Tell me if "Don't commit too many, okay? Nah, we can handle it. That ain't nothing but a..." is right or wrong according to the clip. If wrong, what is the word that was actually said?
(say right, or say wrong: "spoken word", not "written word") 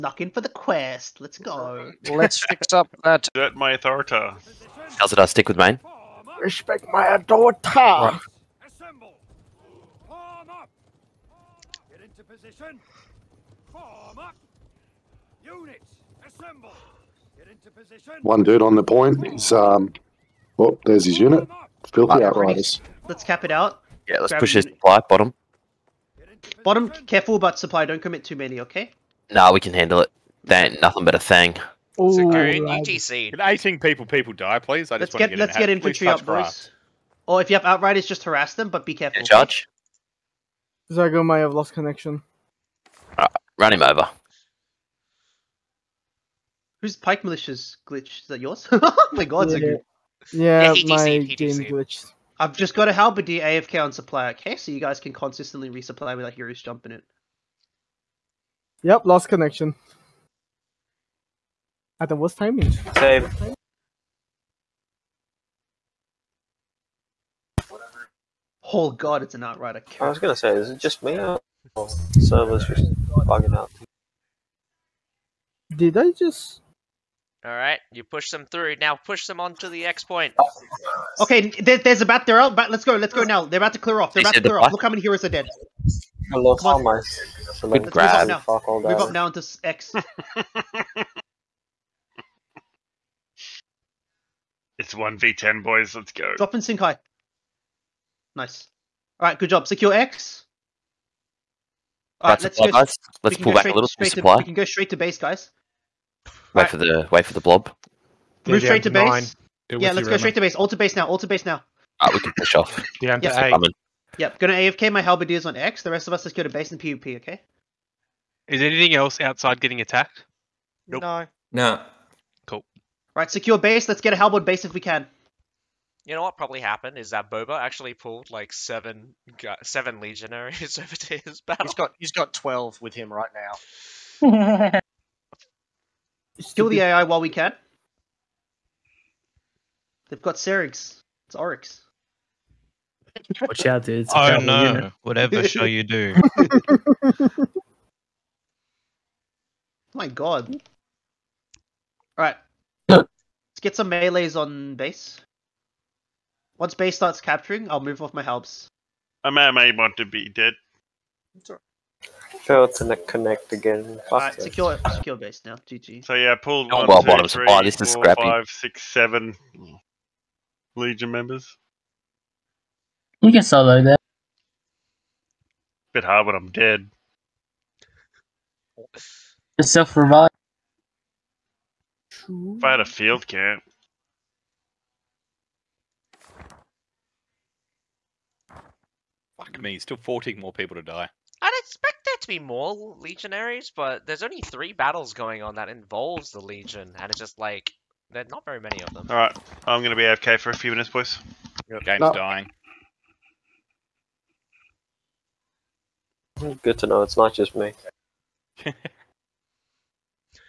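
right.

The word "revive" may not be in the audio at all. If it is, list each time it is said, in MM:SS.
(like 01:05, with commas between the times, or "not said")
02:59.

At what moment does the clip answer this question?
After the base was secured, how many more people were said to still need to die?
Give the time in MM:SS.
03:09.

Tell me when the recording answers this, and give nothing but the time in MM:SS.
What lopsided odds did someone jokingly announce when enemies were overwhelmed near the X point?
01:34.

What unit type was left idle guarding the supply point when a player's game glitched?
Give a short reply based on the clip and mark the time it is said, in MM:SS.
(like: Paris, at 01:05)
Halberdier, at 00:52.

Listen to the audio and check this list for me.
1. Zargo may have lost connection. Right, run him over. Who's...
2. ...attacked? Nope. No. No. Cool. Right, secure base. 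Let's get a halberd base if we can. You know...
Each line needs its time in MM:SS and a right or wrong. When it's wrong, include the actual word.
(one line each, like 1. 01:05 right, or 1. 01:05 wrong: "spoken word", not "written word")
1. 00:40 right
2. 01:59 right.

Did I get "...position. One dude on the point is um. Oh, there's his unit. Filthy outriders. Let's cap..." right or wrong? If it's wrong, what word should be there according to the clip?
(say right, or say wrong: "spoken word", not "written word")
right.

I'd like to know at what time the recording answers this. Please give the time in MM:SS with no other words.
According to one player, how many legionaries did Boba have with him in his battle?
02:12.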